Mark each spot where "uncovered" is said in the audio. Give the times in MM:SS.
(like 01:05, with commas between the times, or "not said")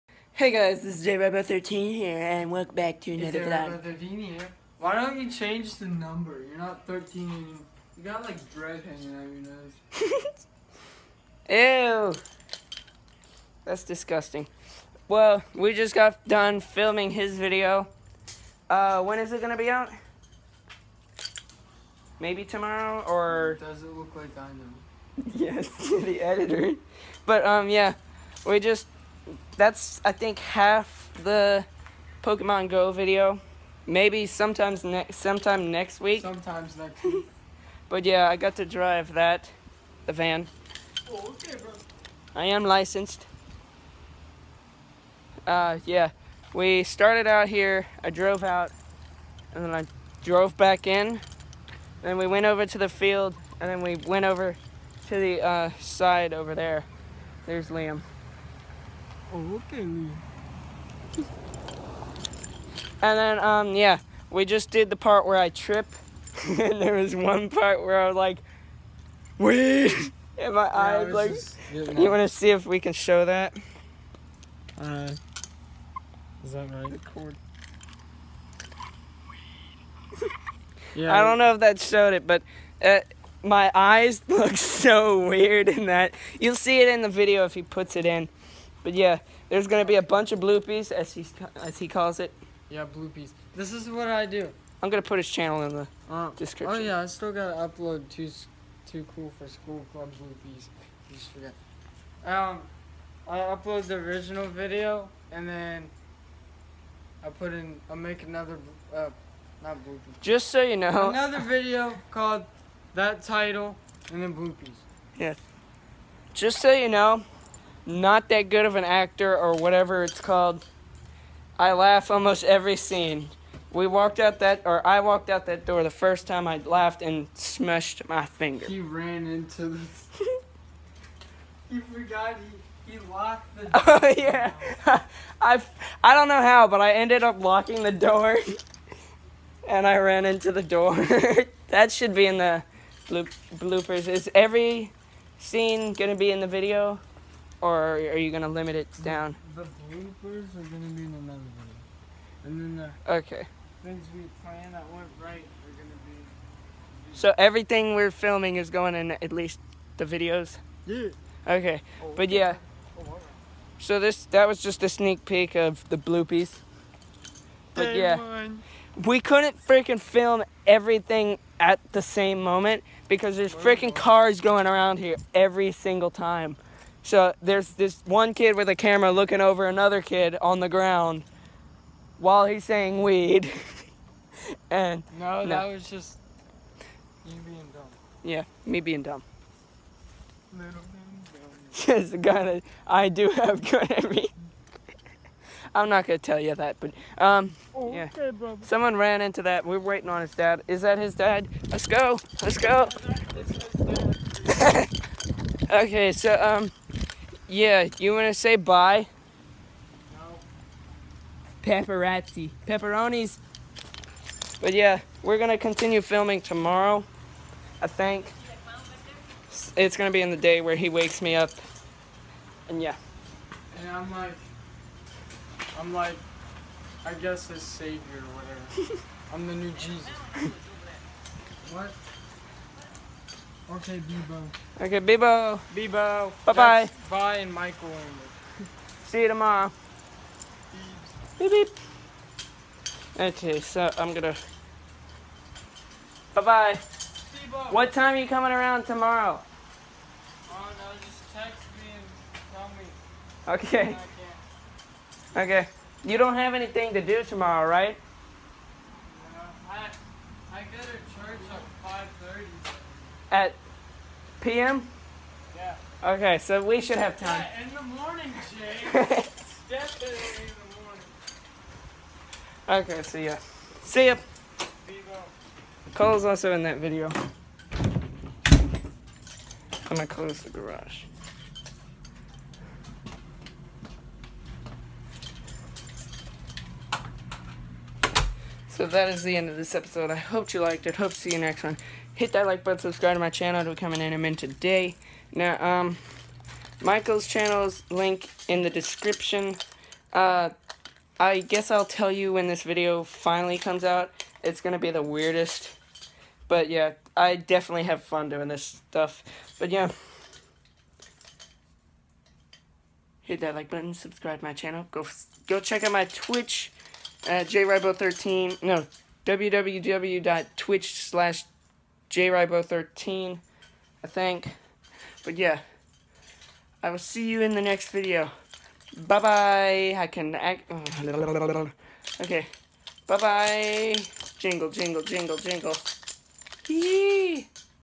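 not said.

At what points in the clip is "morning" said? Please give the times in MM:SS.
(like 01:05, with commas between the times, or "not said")
04:27, 04:32.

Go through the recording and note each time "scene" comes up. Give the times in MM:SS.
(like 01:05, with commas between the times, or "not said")
02:02, 02:25.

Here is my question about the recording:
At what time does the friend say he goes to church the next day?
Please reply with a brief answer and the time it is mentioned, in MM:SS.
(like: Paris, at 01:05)
5:30 p.m., at 04:22.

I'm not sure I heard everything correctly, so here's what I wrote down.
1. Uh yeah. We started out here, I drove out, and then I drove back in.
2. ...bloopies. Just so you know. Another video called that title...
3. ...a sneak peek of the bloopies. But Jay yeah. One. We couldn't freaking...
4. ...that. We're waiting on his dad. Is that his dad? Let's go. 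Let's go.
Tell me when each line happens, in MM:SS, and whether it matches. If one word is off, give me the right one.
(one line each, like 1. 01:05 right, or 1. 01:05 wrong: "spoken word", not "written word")
1. 00:45 right
2. 01:49 right
3. 02:44 wrong: "Day", not "Jay"
4. 03:19 right.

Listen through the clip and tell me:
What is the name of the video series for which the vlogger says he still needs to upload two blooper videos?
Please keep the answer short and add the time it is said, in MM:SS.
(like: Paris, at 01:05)
Cool for School Club, at 01:39.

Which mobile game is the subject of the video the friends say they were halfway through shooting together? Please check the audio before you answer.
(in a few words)
Pokemon Go.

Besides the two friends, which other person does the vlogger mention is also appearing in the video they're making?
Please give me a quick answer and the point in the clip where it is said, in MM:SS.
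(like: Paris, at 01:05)
Cole, at 04:35.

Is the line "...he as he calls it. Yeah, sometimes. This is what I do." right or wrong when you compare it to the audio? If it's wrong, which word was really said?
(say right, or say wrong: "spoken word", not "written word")
wrong: "bloopies", not "sometimes".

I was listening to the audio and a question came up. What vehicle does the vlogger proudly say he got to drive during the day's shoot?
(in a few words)
The van.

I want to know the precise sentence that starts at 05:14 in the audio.
Go go check out my Twitch at JaRyBo13.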